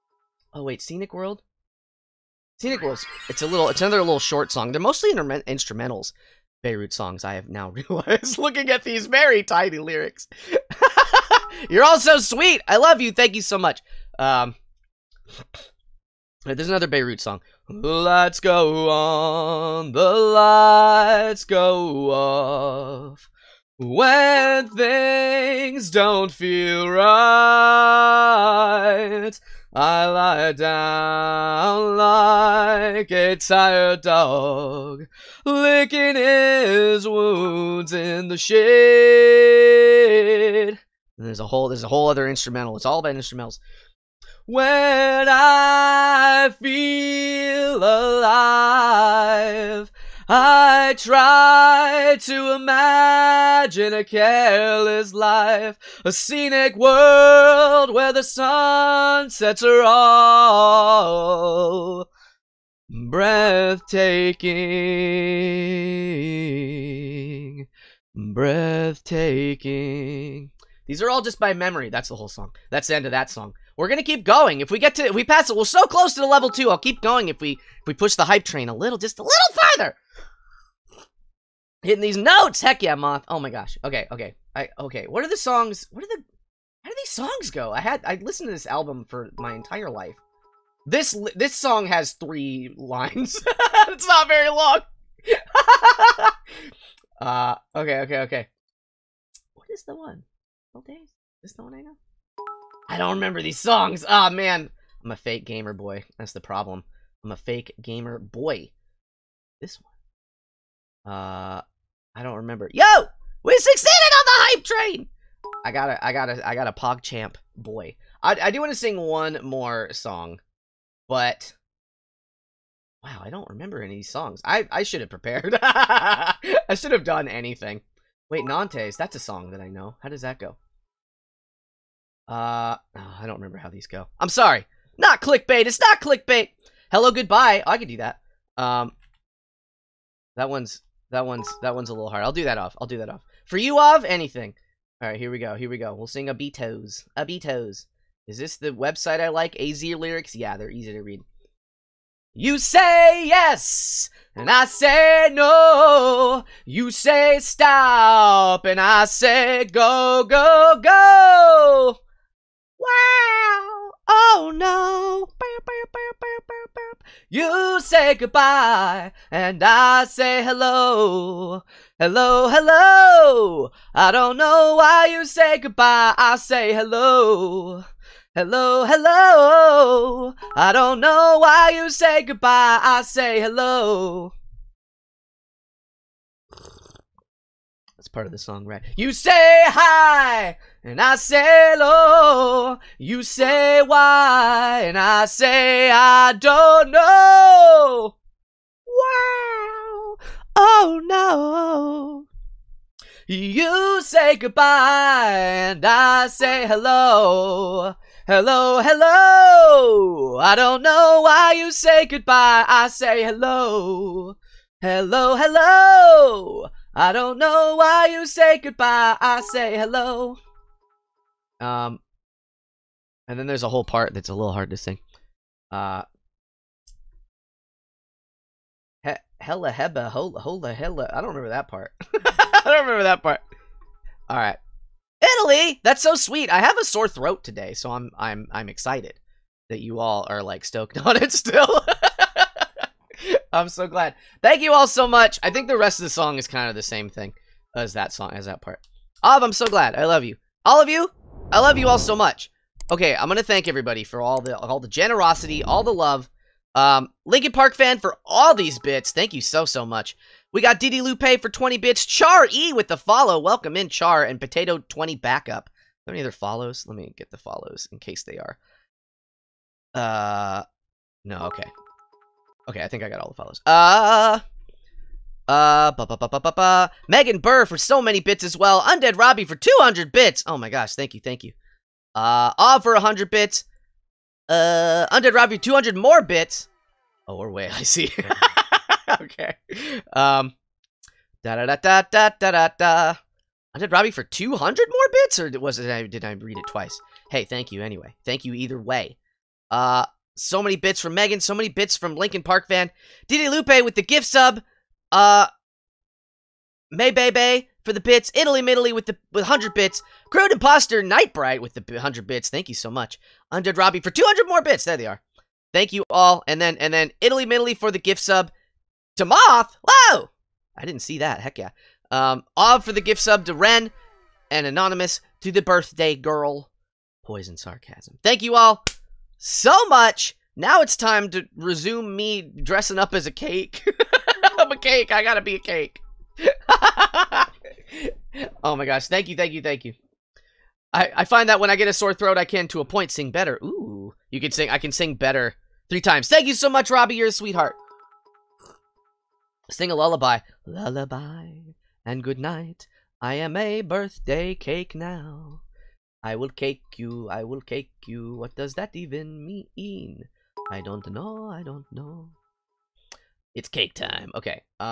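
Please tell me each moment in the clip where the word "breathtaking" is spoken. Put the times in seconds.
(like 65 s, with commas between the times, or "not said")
62 s, 68 s.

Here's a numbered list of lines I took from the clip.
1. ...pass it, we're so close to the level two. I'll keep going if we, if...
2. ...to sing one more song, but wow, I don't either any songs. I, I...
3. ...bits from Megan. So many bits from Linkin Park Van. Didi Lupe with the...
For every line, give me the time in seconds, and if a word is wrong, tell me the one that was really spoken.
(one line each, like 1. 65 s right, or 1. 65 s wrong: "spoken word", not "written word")
1. 75 s right
2. 118 s wrong: "remember", not "either"
3. 300 s right.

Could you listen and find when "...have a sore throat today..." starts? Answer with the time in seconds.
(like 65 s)
236 s.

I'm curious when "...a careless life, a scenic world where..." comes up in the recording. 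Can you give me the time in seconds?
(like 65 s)
53 s.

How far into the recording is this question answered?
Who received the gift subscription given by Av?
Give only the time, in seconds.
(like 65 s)
323 s.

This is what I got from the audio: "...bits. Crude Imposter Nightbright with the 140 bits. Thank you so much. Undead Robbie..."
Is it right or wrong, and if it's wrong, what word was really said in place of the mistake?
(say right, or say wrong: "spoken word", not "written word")
wrong: "100", not "140".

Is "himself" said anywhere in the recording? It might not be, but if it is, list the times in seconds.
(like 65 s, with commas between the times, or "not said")
not said.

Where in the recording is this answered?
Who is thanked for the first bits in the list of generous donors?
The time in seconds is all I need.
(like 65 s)
257 s.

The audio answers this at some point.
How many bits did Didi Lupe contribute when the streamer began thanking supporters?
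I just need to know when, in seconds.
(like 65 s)
261 s.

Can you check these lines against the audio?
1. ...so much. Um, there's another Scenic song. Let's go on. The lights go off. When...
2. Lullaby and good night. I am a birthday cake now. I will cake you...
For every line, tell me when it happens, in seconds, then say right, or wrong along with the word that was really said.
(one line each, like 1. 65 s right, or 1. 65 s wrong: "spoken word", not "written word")
1. 13 s wrong: "Beirut", not "Scenic"
2. 350 s right.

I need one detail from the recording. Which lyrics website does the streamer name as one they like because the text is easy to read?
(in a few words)
AZ lyrics.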